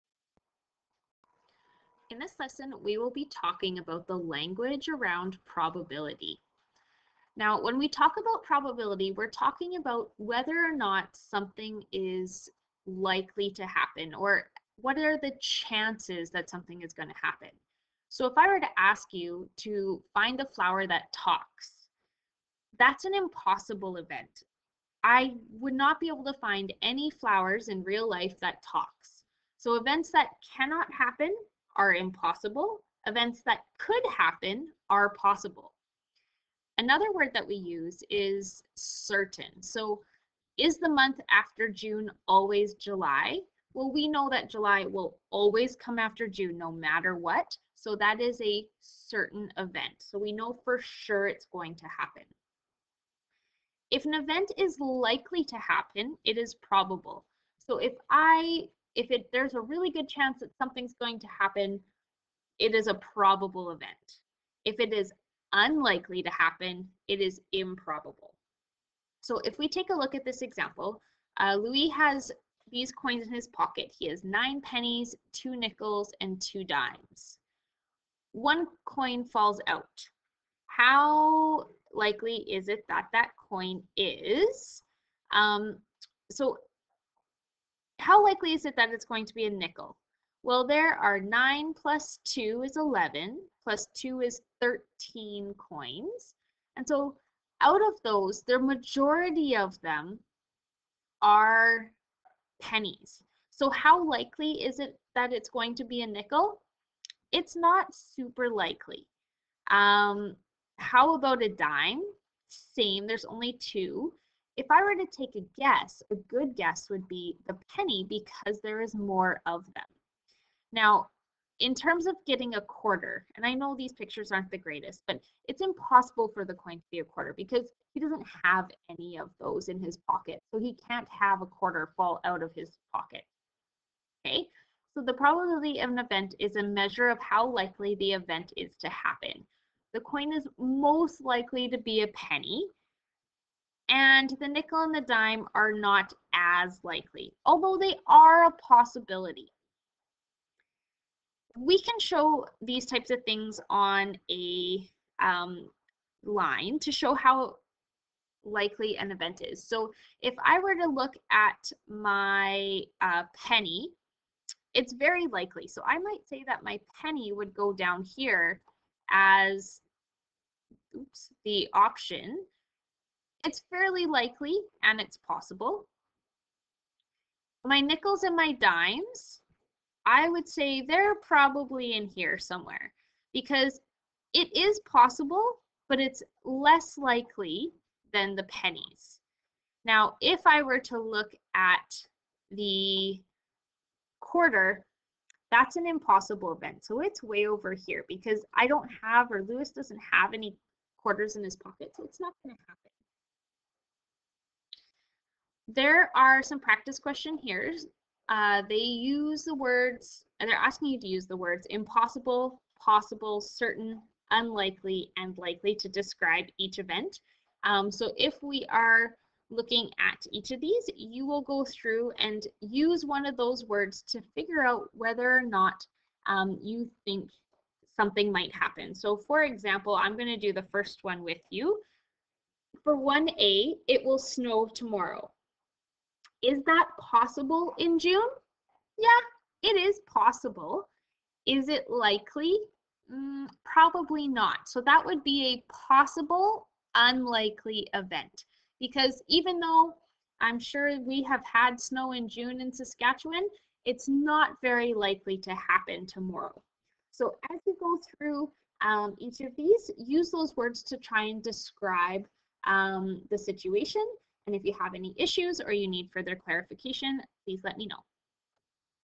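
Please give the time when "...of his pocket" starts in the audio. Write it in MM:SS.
02:12.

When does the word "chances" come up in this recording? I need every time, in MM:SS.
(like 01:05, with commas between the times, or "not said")
00:15, 01:00.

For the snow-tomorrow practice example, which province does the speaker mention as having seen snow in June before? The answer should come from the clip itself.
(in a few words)
Saskatchewan.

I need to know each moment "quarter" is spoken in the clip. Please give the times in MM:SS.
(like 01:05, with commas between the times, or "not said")
02:02, 02:07, 02:11, 03:14, 03:20.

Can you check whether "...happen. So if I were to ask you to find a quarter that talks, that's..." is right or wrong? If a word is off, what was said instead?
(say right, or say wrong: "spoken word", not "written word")
wrong: "flower", not "quarter".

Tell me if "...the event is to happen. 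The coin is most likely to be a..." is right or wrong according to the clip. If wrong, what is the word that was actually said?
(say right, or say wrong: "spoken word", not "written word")
right.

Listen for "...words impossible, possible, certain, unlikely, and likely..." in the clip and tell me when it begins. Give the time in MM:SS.
03:31.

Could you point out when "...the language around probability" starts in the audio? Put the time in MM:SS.
00:04.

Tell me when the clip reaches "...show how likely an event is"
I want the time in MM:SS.
02:36.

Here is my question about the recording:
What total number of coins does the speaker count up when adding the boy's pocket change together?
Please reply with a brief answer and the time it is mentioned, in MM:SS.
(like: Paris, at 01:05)
13, at 01:34.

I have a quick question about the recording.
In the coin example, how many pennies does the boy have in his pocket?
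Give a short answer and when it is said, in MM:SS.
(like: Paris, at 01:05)
9, at 01:14.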